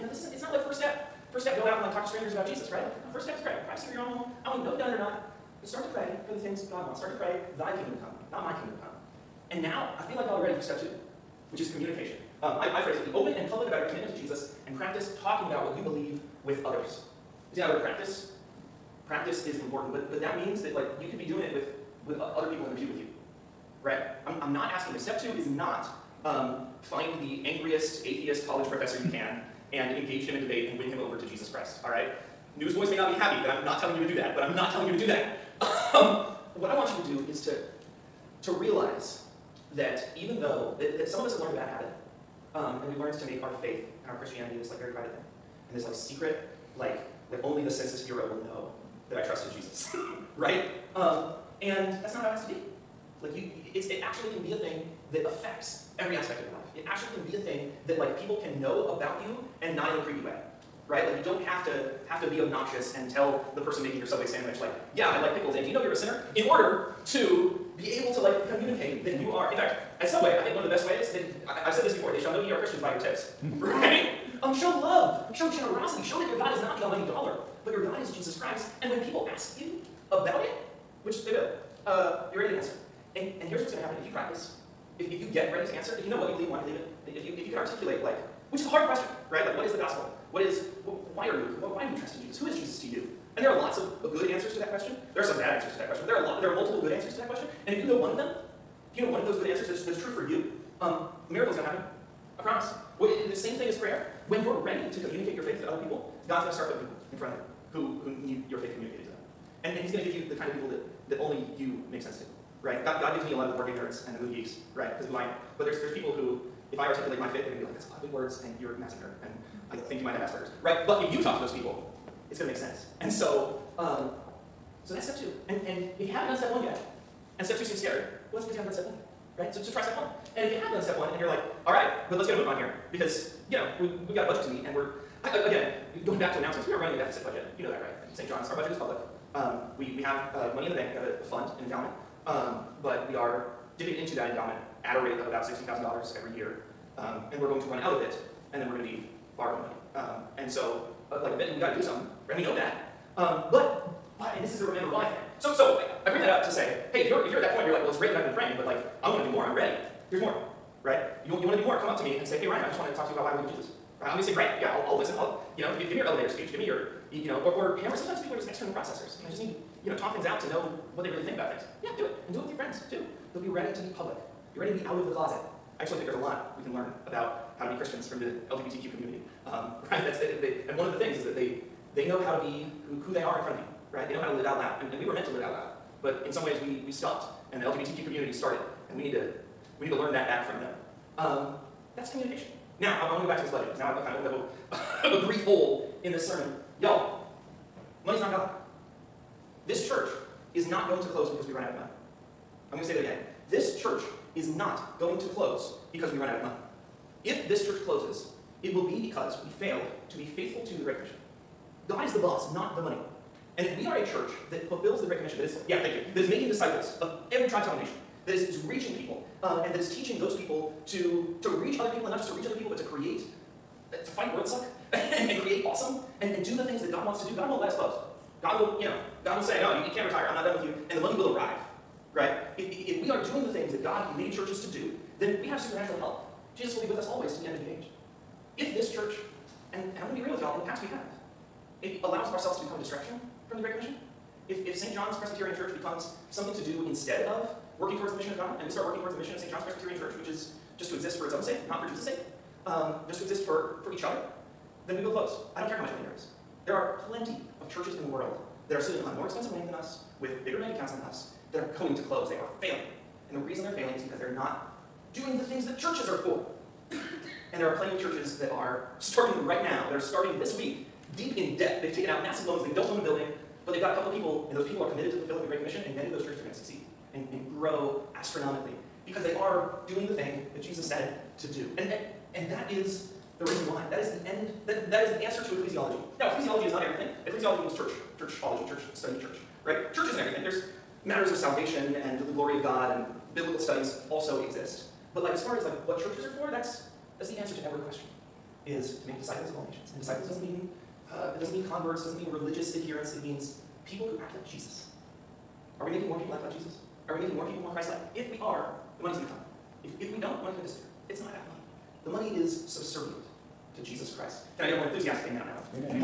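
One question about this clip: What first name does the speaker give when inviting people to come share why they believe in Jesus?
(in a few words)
Ryan.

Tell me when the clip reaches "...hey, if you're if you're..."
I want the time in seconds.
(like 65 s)
156 s.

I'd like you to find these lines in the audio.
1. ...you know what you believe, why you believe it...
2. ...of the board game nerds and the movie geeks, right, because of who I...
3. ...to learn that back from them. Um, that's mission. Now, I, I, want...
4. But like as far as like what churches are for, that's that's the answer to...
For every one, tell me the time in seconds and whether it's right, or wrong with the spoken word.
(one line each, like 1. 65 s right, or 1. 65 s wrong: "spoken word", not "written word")
1. 86 s right
2. 113 s right
3. 189 s wrong: "communication", not "mission"
4. 295 s right.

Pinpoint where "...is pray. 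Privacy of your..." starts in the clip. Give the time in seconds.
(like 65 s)
3 s.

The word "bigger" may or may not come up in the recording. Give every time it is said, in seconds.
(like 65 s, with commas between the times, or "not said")
260 s.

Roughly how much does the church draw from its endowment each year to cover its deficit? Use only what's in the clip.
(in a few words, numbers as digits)
$60,000.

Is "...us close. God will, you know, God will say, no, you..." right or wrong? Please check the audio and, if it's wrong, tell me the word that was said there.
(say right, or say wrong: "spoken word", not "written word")
right.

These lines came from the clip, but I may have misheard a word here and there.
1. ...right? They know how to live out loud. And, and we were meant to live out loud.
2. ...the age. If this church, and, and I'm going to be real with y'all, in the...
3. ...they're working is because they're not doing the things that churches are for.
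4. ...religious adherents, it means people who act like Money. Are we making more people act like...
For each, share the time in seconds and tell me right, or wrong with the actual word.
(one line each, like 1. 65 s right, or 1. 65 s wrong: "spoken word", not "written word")
1. 183 s right
2. 237 s right
3. 263 s wrong: "failing", not "working"
4. 302 s wrong: "Jesus", not "Money".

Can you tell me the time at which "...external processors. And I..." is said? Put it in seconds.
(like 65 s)
168 s.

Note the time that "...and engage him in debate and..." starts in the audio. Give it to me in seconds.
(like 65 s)
29 s.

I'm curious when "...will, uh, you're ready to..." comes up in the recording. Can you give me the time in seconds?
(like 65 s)
81 s.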